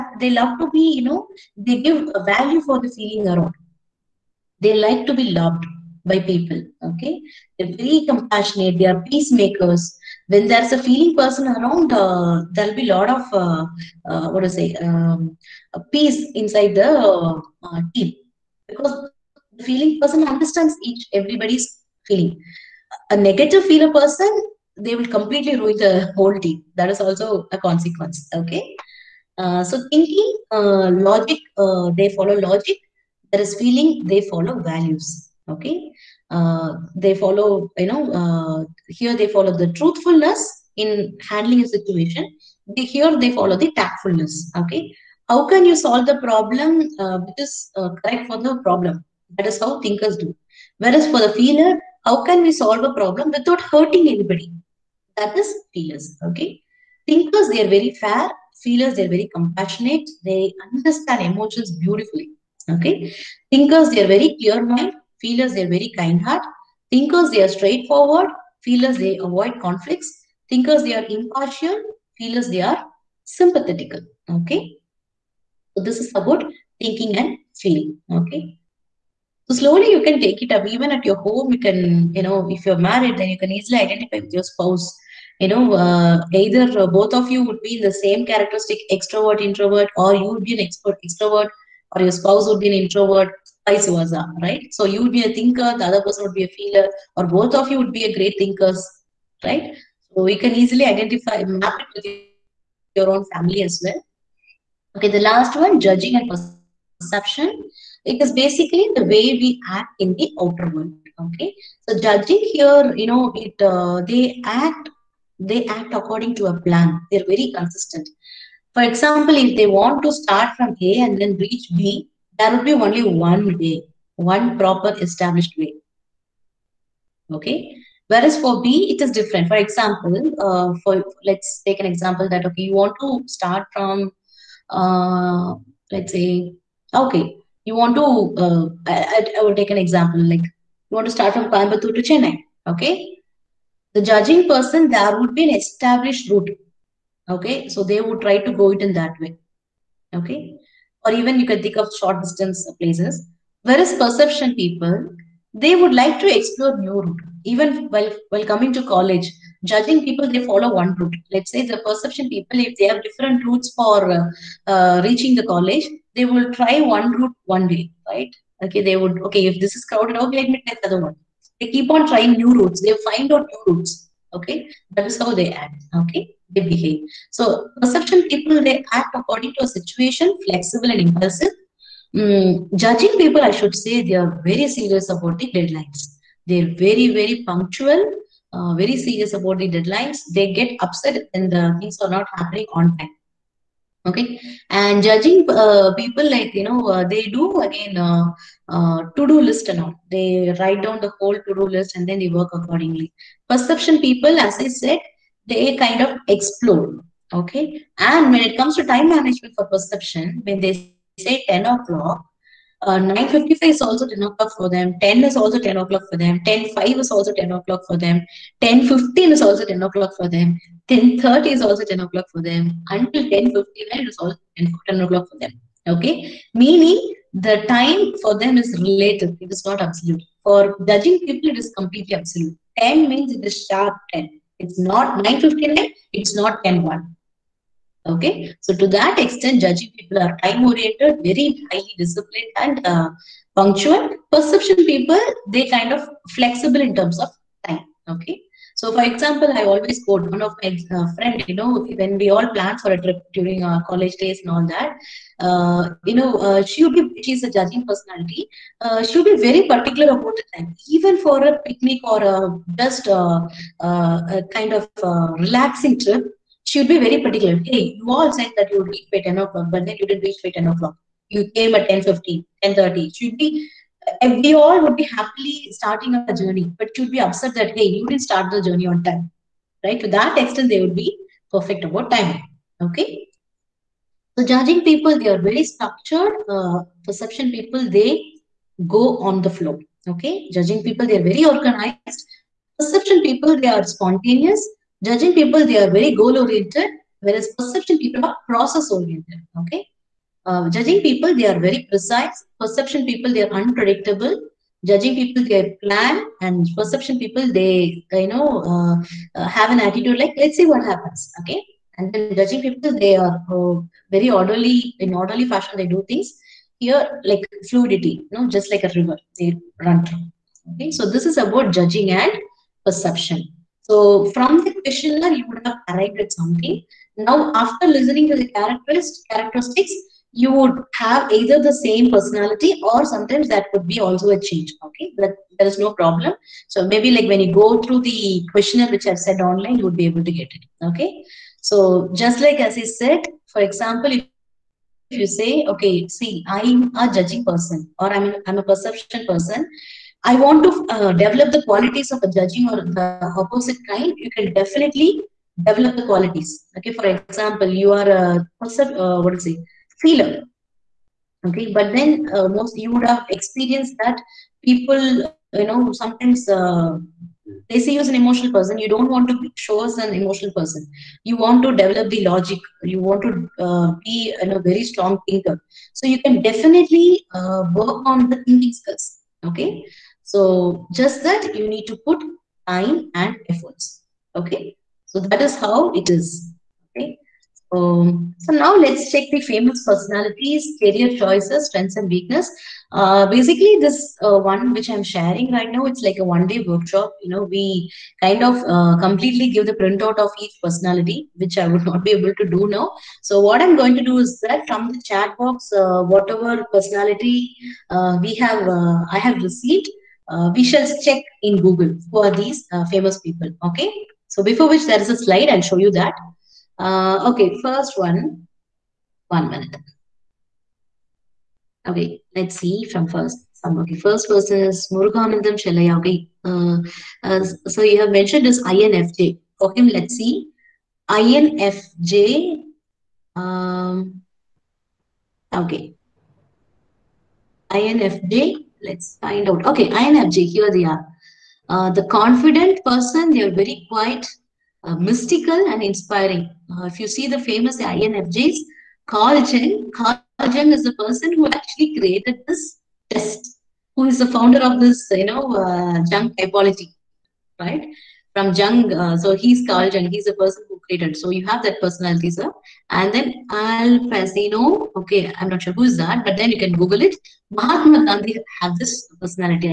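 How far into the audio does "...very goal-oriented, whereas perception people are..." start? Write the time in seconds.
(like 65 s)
295 s.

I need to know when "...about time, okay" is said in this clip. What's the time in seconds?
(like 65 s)
281 s.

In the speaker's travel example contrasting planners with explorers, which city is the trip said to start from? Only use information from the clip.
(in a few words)
Coimbatore.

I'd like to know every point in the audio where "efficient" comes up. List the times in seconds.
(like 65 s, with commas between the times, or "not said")
not said.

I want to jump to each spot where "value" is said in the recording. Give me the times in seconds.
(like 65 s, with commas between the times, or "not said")
2 s, 34 s.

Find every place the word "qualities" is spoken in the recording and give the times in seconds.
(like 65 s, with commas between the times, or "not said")
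351 s, 356 s.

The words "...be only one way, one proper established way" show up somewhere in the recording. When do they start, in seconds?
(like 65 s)
122 s.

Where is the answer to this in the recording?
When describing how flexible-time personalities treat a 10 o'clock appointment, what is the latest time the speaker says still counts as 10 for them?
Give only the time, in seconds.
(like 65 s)
223 s.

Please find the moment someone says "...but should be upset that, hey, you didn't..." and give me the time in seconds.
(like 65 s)
276 s.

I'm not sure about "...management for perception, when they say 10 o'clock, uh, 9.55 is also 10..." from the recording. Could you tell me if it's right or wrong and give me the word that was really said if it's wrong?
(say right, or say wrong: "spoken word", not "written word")
right.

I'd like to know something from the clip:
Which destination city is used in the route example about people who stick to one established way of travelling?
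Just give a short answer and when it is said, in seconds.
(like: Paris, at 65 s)
Chennai, at 142 s.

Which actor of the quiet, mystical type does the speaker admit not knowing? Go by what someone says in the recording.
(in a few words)
Al Pacino.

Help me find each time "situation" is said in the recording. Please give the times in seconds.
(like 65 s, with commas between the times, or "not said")
41 s, 179 s.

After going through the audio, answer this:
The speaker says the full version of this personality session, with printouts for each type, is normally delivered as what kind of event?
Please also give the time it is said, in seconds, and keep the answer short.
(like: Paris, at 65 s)
One-day workshop, at 396 s.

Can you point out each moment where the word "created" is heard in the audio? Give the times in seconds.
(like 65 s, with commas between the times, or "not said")
451 s, 460 s.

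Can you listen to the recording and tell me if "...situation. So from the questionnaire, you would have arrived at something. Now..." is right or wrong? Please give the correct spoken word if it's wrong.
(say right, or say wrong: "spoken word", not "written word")
wrong: "perception", not "situation".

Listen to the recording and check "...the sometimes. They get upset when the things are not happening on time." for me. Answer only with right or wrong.
wrong.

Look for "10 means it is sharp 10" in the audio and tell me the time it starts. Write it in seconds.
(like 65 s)
232 s.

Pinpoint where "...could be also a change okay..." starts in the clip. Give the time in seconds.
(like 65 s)
333 s.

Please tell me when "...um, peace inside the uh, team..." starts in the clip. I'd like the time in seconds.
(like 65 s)
14 s.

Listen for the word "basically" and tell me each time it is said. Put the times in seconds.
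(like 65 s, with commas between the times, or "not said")
108 s, 393 s.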